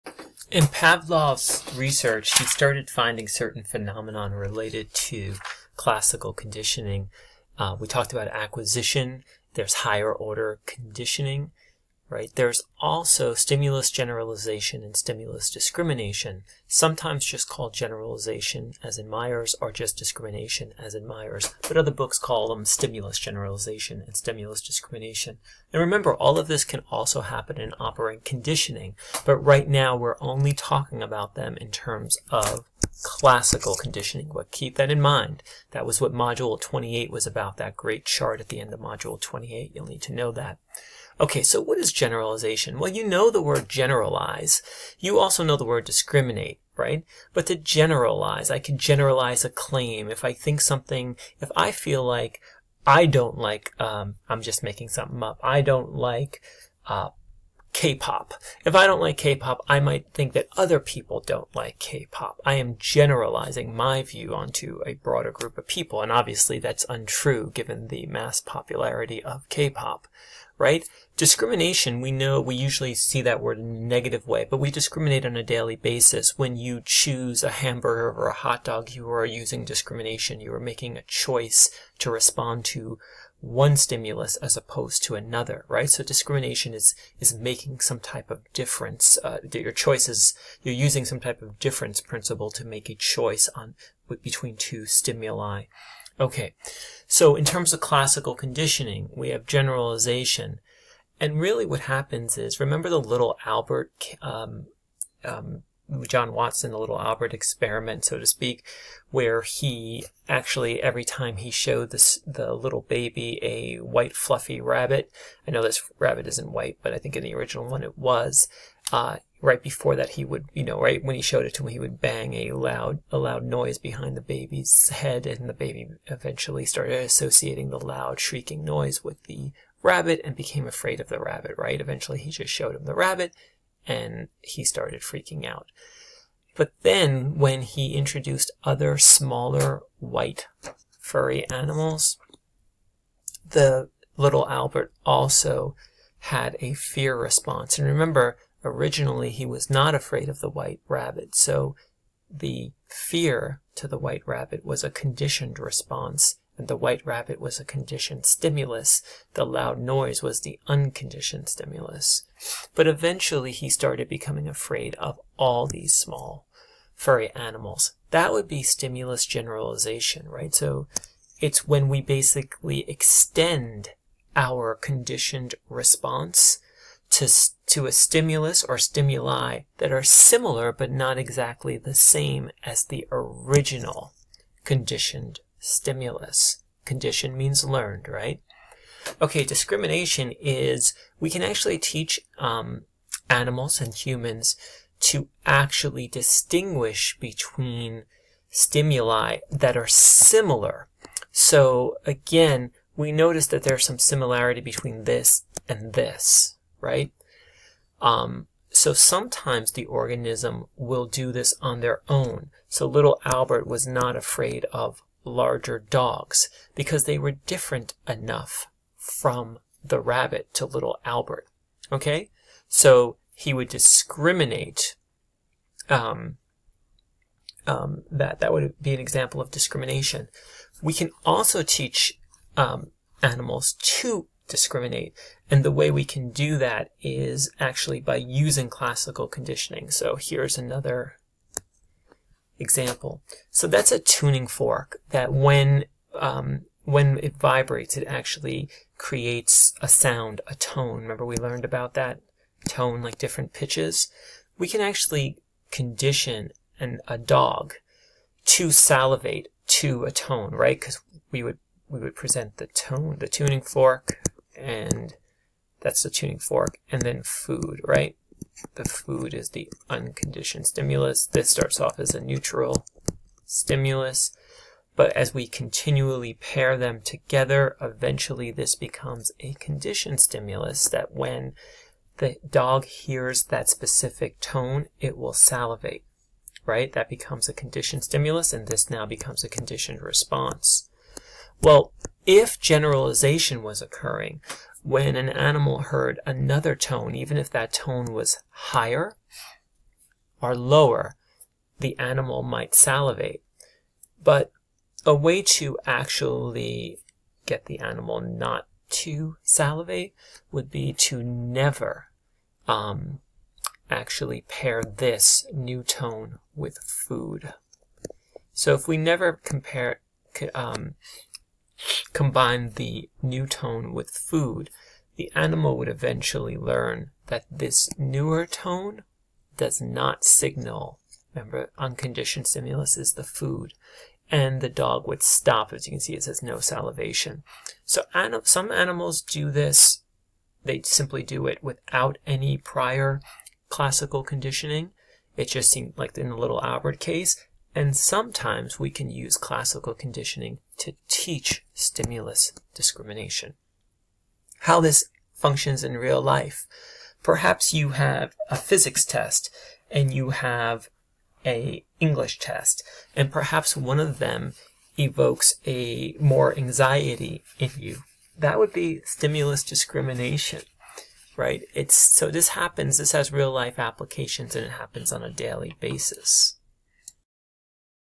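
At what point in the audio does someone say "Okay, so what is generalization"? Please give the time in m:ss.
0:41.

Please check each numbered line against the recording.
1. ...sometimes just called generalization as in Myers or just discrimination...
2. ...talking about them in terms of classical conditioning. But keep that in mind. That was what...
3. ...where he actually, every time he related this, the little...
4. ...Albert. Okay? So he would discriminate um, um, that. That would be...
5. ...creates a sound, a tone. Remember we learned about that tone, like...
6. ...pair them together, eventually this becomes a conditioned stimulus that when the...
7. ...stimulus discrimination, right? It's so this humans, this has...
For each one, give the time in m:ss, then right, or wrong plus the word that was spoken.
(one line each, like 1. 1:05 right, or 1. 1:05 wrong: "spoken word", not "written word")
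1. 0:16 right
2. 0:30 right
3. 1:49 wrong: "showed", not "related"
4. 3:41 right
5. 4:08 right
6. 4:36 right
7. 6:09 wrong: "happens", not "humans".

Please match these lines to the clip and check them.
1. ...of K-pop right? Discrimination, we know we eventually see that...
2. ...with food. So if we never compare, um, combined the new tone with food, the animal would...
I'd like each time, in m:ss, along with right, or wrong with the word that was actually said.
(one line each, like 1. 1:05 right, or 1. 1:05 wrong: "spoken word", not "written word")
1. 1:09 wrong: "usually", not "eventually"
2. 5:16 right.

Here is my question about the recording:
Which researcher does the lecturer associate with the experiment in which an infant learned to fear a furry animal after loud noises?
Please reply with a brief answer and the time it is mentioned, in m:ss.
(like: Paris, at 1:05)
John Watson, at 1:46.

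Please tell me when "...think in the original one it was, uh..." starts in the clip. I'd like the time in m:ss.
1:56.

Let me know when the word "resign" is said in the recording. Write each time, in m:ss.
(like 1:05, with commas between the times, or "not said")
not said.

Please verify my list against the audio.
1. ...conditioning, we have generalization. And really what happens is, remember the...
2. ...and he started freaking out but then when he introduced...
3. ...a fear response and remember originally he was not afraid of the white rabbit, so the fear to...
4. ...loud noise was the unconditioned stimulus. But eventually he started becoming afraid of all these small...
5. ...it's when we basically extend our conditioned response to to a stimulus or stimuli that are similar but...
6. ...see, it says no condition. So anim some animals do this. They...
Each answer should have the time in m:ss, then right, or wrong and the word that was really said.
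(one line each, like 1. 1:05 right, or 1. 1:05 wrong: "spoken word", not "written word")
1. 1:38 right
2. 2:13 right
3. 2:26 right
4. 2:39 right
5. 2:51 right
6. 5:35 wrong: "salivation", not "condition".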